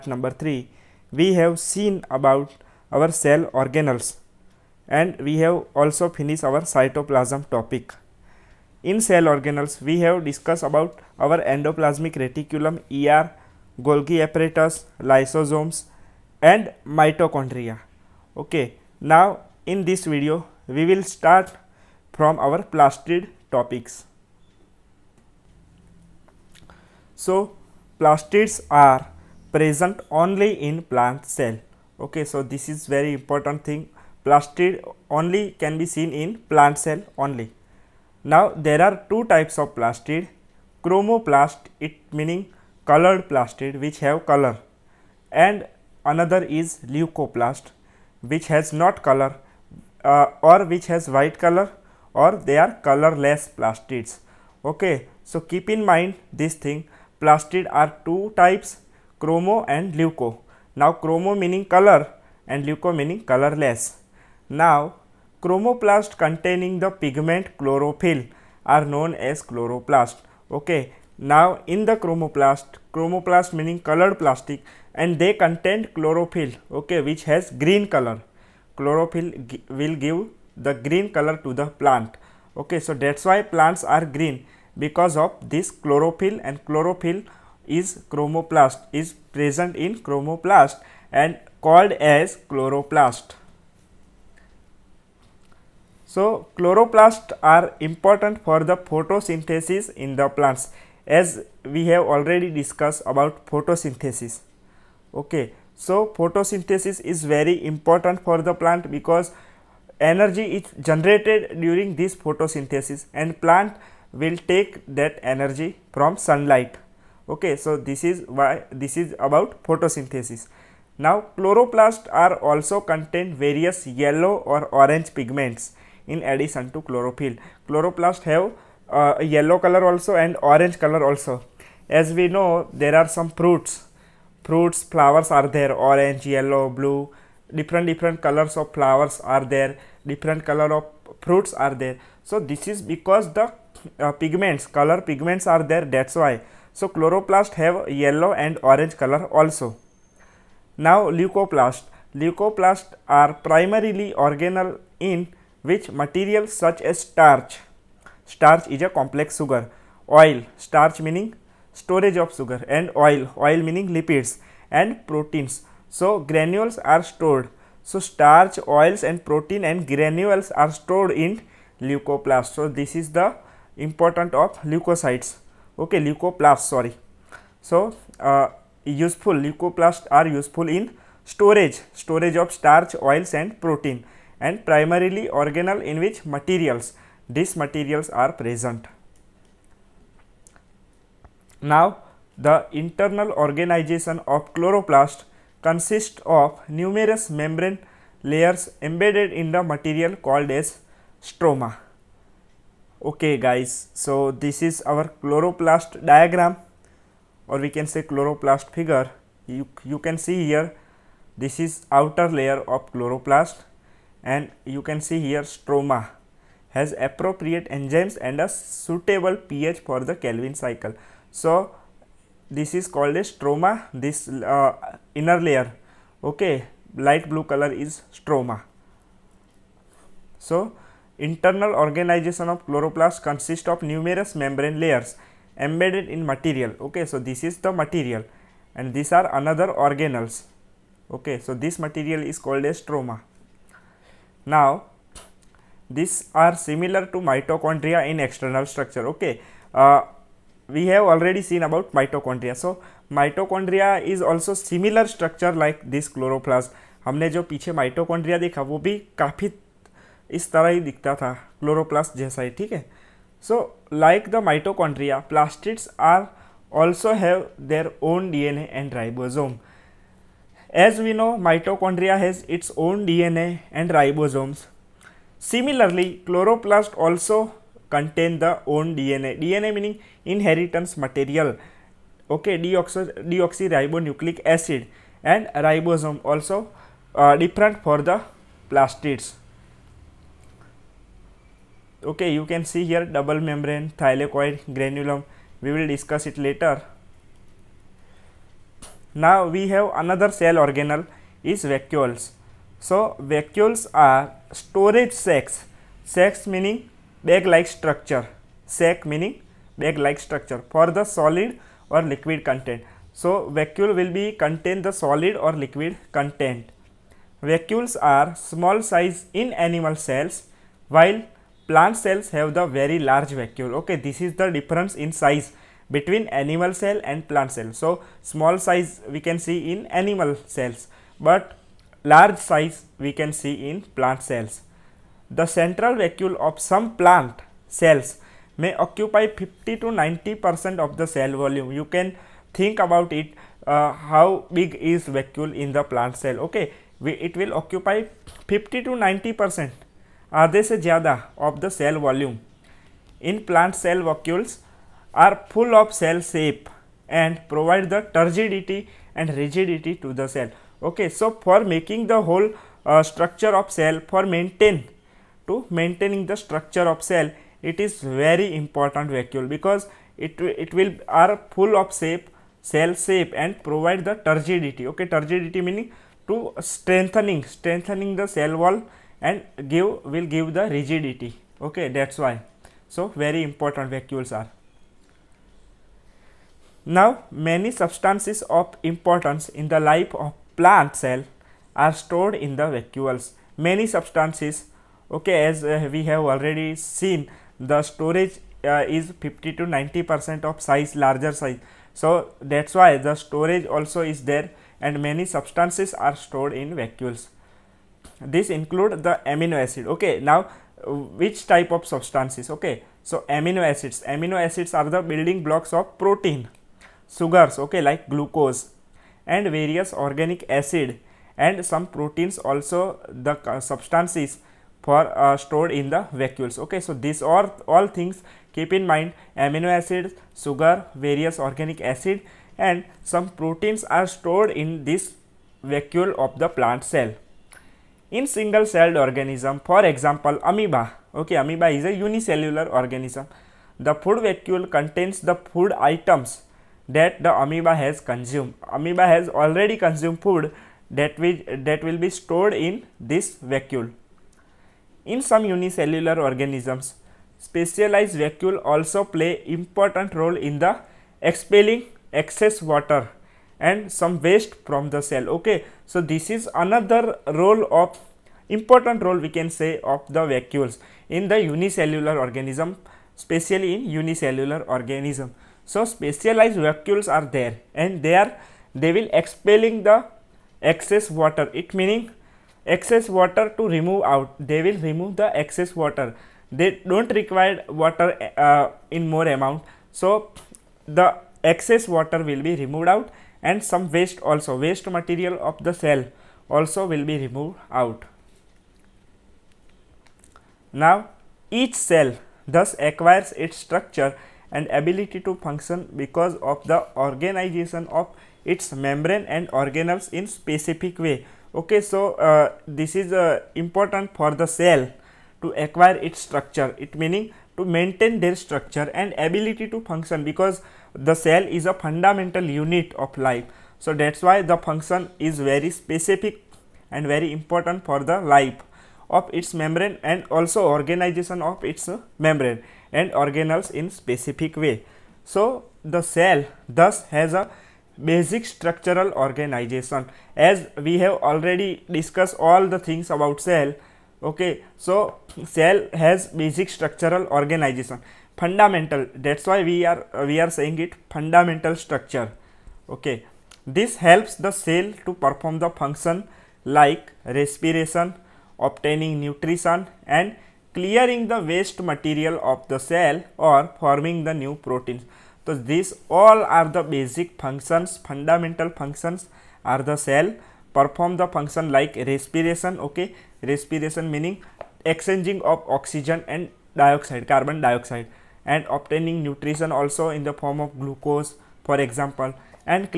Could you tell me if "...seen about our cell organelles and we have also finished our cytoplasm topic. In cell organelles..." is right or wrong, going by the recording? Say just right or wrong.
right.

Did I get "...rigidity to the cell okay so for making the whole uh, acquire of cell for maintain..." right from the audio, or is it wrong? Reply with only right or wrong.
wrong.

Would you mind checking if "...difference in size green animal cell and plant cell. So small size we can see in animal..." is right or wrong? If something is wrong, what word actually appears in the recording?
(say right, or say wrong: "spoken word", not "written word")
wrong: "between", not "green".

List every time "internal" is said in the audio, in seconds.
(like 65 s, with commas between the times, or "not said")
192 s, 231 s.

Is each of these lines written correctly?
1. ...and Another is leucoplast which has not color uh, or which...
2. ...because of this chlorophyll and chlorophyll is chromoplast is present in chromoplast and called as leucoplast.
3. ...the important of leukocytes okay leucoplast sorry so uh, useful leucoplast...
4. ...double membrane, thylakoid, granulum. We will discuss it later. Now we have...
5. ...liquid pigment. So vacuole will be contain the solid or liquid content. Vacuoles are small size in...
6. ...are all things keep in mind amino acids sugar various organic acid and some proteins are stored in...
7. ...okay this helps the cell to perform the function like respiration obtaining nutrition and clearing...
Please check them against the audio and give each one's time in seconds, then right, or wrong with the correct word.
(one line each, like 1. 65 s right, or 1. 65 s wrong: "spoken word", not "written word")
1. 45 s right
2. 84 s wrong: "chloroplast", not "leucoplast"
3. 173 s right
4. 293 s right
5. 312 s wrong: "content", not "pigment"
6. 427 s right
7. 552 s right.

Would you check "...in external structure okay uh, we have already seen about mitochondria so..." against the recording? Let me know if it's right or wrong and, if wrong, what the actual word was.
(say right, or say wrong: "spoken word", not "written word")
right.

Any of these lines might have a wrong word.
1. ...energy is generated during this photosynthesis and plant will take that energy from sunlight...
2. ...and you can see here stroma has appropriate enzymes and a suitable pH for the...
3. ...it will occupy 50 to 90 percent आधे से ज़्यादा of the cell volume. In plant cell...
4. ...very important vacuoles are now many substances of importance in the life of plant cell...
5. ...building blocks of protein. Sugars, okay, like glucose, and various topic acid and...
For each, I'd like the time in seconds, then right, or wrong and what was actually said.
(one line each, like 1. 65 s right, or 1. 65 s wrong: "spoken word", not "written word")
1. 109 s right
2. 214 s right
3. 347 s right
4. 383 s right
5. 415 s wrong: "organic", not "topic".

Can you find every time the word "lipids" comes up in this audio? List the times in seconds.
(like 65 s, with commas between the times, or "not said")
163 s.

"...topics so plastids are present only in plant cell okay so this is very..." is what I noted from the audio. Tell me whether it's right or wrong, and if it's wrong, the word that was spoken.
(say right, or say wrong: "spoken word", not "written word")
right.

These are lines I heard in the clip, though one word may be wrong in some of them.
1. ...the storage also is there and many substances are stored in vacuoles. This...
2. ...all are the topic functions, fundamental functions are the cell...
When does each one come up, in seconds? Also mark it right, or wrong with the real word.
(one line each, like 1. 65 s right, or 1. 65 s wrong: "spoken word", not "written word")
1. 402 s right
2. 566 s wrong: "basic", not "topic".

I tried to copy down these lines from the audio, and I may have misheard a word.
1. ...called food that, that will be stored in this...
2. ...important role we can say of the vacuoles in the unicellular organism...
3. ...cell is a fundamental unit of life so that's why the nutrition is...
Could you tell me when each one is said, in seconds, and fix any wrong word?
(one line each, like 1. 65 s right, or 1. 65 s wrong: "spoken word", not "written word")
1. 449 s wrong: "consumed", not "called"
2. 468 s right
3. 521 s wrong: "function", not "nutrition".